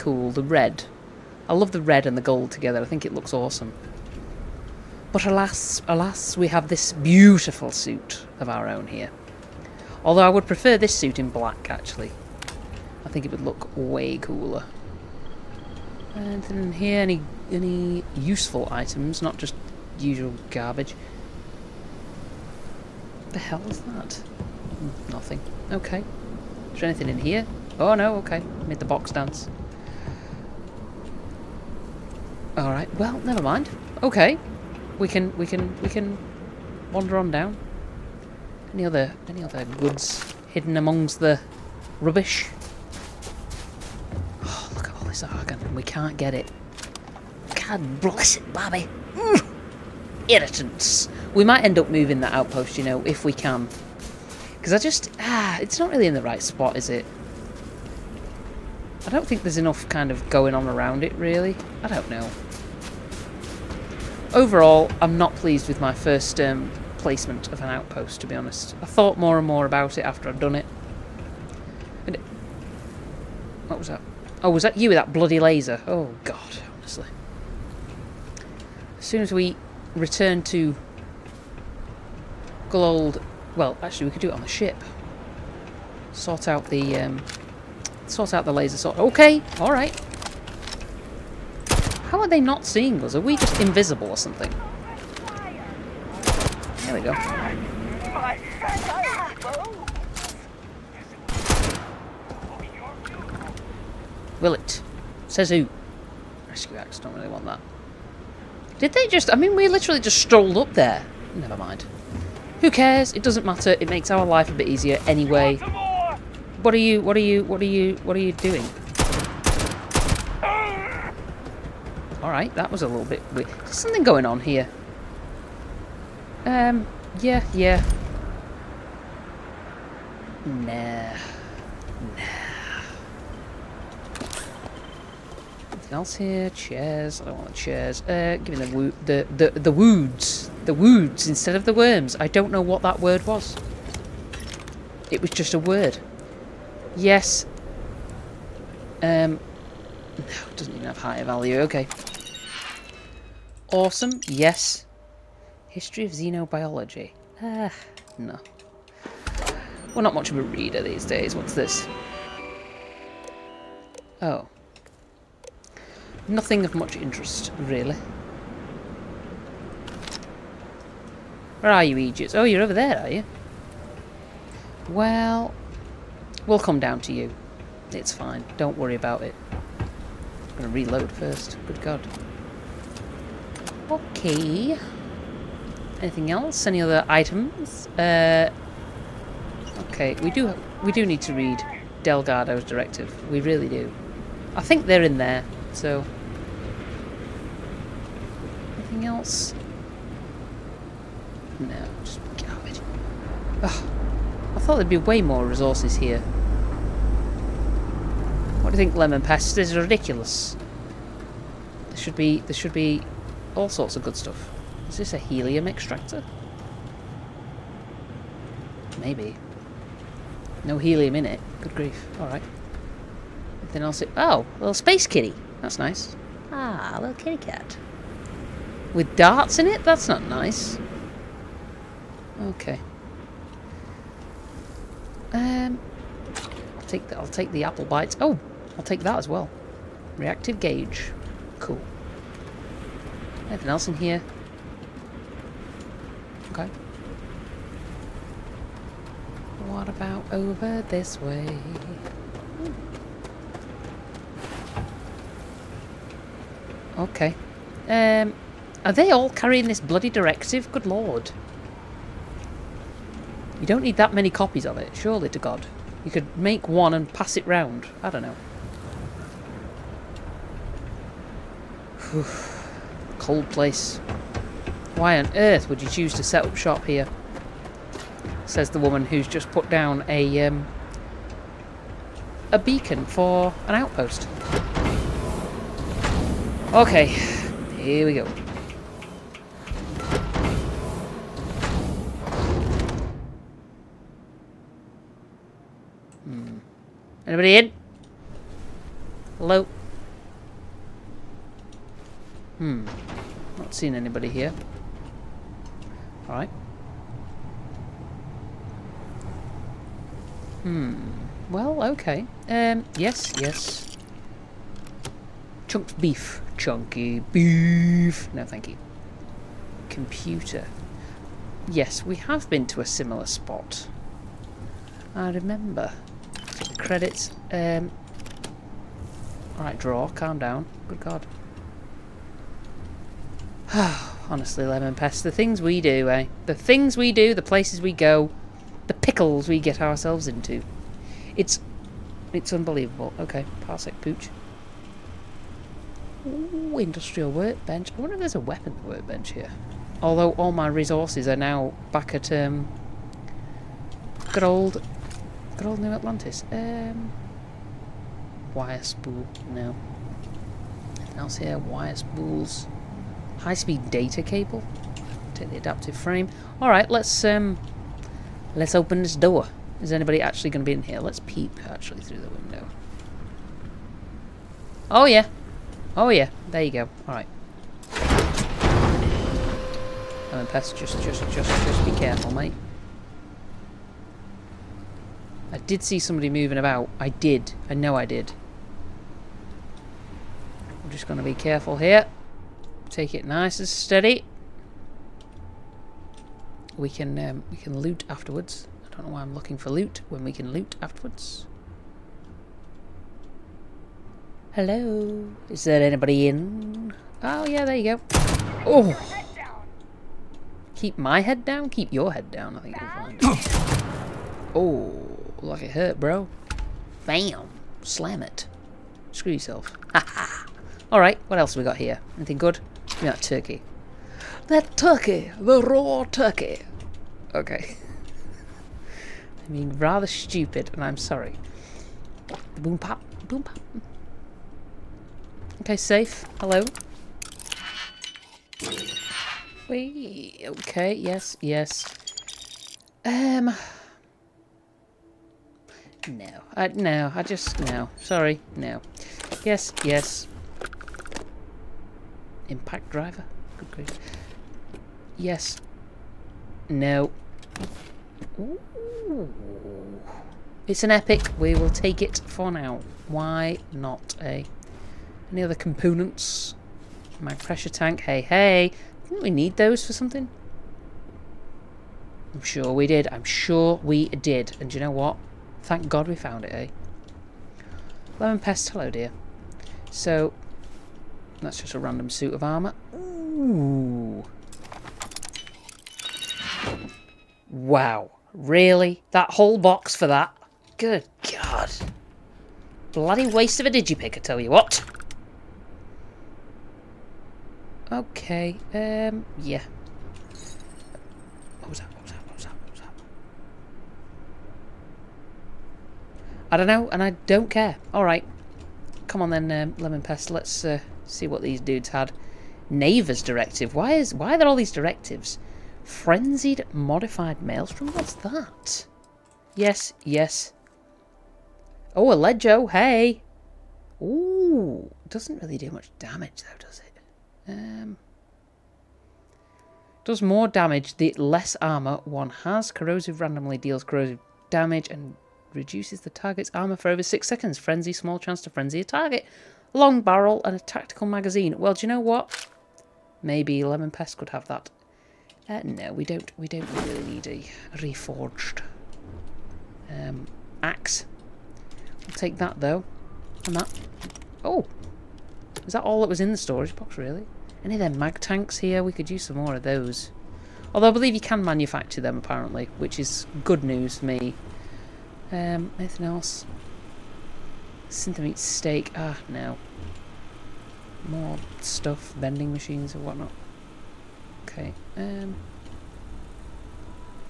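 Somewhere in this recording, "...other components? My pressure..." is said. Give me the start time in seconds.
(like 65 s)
465 s.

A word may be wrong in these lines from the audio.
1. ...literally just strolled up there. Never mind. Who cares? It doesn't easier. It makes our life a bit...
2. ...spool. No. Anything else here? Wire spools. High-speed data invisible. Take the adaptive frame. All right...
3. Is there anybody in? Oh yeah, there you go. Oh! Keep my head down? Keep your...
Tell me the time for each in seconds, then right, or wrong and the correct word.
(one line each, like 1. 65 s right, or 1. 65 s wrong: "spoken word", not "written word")
1. 109 s wrong: "matter", not "easier"
2. 358 s wrong: "cable", not "invisible"
3. 405 s right.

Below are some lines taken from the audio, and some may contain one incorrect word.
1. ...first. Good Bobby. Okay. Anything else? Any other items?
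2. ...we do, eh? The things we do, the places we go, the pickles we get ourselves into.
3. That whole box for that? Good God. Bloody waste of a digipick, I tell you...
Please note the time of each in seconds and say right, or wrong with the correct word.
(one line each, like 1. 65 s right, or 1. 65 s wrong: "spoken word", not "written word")
1. 181 s wrong: "God", not "Bobby"
2. 335 s right
3. 489 s right.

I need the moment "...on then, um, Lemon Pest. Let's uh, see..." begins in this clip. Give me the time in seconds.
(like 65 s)
509 s.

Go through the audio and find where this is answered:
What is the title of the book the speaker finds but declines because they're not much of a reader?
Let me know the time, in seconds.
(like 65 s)
155 s.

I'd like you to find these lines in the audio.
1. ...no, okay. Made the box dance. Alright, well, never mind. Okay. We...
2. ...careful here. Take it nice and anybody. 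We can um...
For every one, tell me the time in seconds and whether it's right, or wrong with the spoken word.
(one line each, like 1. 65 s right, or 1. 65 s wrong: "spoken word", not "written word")
1. 27 s right
2. 391 s wrong: "steady", not "anybody".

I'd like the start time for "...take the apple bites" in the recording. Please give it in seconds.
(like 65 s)
237 s.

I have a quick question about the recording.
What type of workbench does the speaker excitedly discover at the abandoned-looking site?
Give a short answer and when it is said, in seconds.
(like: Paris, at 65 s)
industrial workbench, at 346 s.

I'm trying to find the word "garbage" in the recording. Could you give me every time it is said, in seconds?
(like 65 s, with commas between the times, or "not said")
20 s, 202 s.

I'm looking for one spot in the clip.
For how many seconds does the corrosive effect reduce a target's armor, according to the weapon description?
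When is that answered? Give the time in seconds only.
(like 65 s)
537 s.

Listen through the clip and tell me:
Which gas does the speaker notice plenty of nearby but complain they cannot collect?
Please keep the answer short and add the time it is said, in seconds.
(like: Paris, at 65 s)
argon, at 45 s.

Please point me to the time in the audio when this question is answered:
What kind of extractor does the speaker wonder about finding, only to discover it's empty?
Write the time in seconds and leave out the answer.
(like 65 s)
215 s.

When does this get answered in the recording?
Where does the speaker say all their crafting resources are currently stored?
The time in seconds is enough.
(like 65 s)
355 s.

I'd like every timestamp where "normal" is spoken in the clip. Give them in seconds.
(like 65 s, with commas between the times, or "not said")
not said.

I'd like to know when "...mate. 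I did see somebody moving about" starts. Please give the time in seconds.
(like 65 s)
382 s.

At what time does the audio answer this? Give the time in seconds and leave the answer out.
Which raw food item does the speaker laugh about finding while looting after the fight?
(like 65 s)
425 s.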